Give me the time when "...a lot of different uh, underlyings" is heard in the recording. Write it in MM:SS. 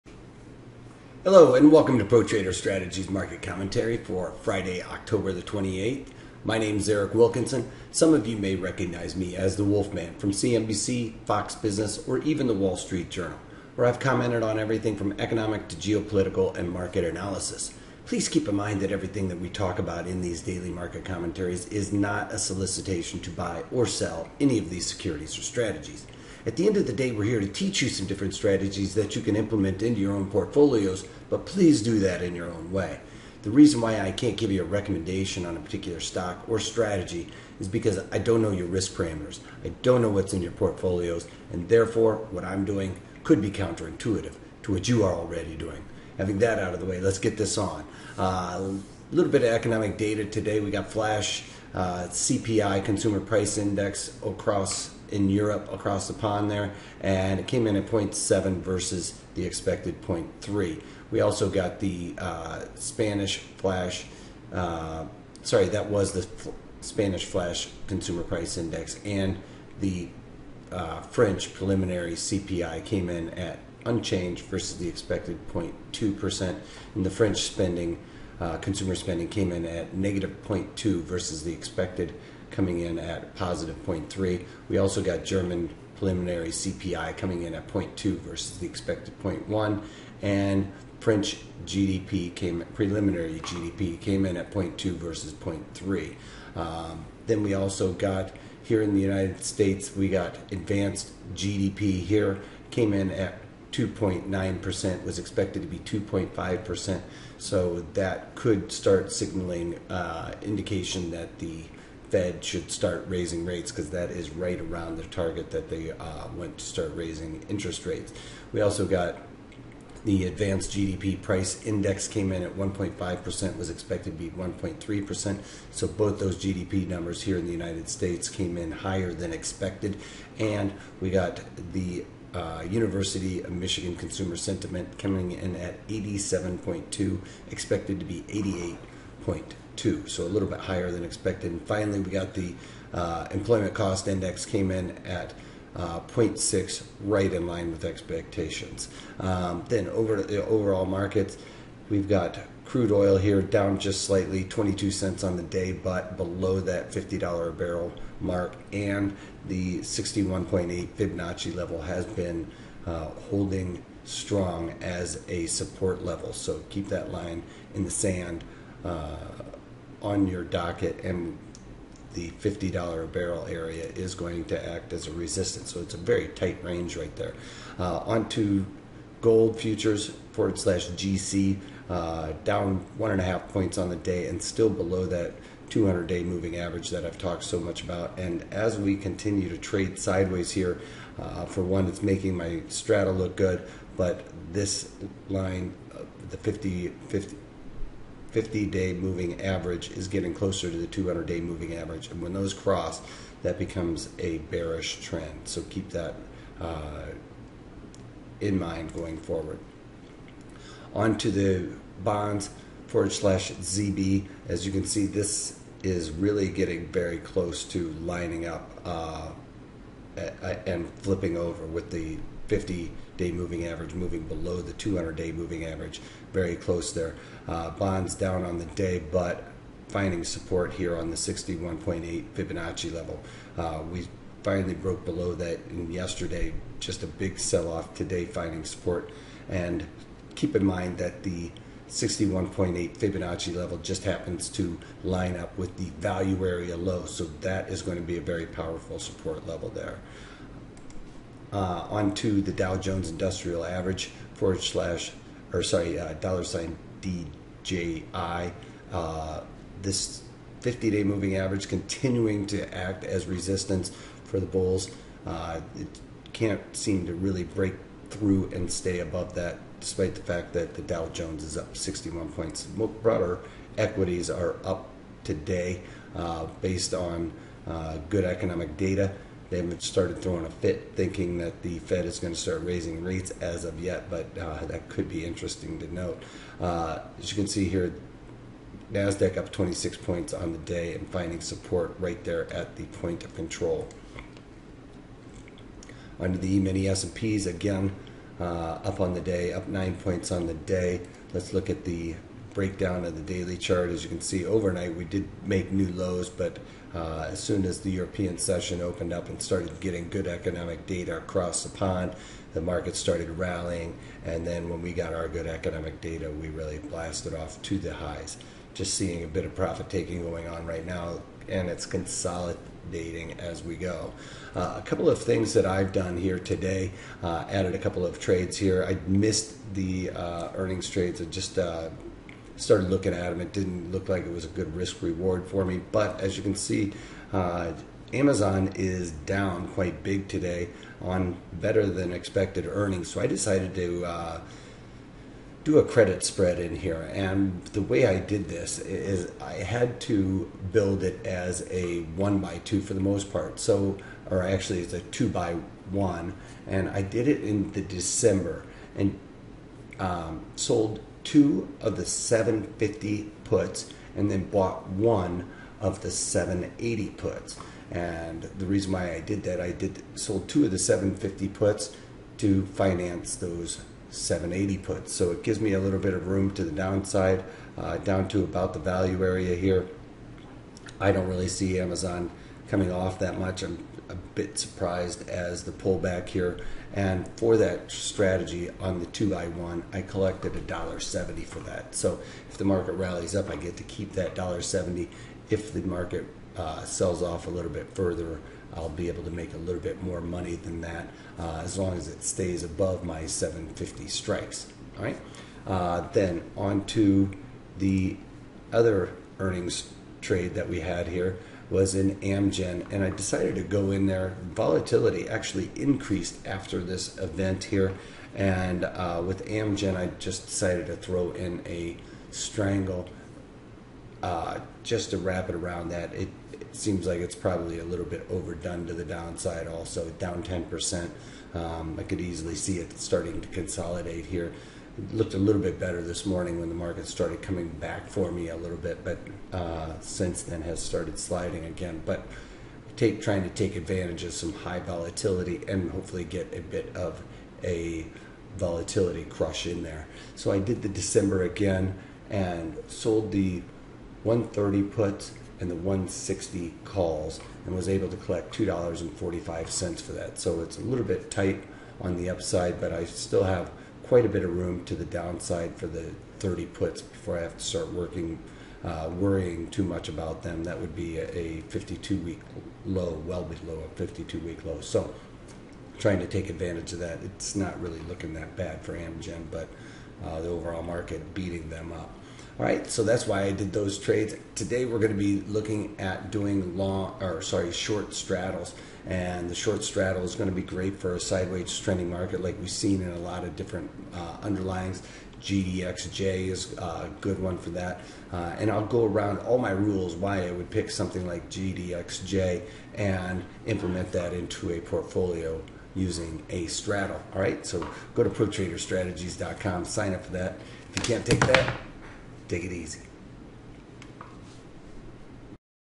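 08:13.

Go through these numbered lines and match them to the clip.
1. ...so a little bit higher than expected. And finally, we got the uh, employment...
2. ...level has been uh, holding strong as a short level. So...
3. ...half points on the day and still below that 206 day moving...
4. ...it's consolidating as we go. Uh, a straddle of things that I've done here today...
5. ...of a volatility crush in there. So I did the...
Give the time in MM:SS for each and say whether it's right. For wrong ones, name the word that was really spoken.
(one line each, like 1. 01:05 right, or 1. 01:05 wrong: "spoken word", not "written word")
1. 02:20 right
2. 02:41 wrong: "support", not "short"
3. 03:03 wrong: "200", not "206"
4. 05:21 wrong: "couple", not "straddle"
5. 07:26 right.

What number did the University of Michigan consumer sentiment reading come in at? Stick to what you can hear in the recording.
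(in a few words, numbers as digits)
87.2.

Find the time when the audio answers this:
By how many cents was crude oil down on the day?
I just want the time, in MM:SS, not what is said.
02:34.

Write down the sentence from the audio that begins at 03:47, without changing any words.
Uh, bonds down on the day, but finding support here on the 61.8 Fibonacci level.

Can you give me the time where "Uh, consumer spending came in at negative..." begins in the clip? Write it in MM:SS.
01:18.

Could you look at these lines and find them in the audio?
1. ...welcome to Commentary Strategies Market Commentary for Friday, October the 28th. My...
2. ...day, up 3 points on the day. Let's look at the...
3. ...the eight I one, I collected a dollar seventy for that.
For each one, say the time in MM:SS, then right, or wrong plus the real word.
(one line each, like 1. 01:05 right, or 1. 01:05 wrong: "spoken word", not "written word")
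1. 00:01 wrong: "ProTrader", not "Commentary"
2. 04:59 wrong: "9", not "3"
3. 06:28 wrong: "two", not "eight".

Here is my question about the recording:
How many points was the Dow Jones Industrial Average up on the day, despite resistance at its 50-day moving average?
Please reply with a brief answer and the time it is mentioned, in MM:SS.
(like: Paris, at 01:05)
61 points, at 04:31.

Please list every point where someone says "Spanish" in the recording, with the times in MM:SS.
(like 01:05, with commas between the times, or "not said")
01:02, 01:06.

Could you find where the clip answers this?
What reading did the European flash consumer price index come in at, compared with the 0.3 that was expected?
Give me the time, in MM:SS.
00:57.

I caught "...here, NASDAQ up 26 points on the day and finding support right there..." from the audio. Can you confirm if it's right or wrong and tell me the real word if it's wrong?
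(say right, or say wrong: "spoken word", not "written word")
right.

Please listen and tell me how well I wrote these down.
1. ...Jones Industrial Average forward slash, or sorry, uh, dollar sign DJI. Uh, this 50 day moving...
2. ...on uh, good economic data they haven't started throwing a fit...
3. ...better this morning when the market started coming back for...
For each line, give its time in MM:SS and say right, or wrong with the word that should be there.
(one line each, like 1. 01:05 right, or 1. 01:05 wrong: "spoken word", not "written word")
1. 04:12 right
2. 04:36 right
3. 07:15 right.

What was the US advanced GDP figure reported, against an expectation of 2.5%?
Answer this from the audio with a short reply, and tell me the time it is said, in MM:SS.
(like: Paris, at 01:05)
2.9%, at 01:43.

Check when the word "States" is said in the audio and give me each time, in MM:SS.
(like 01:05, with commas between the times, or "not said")
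01:39, 02:07.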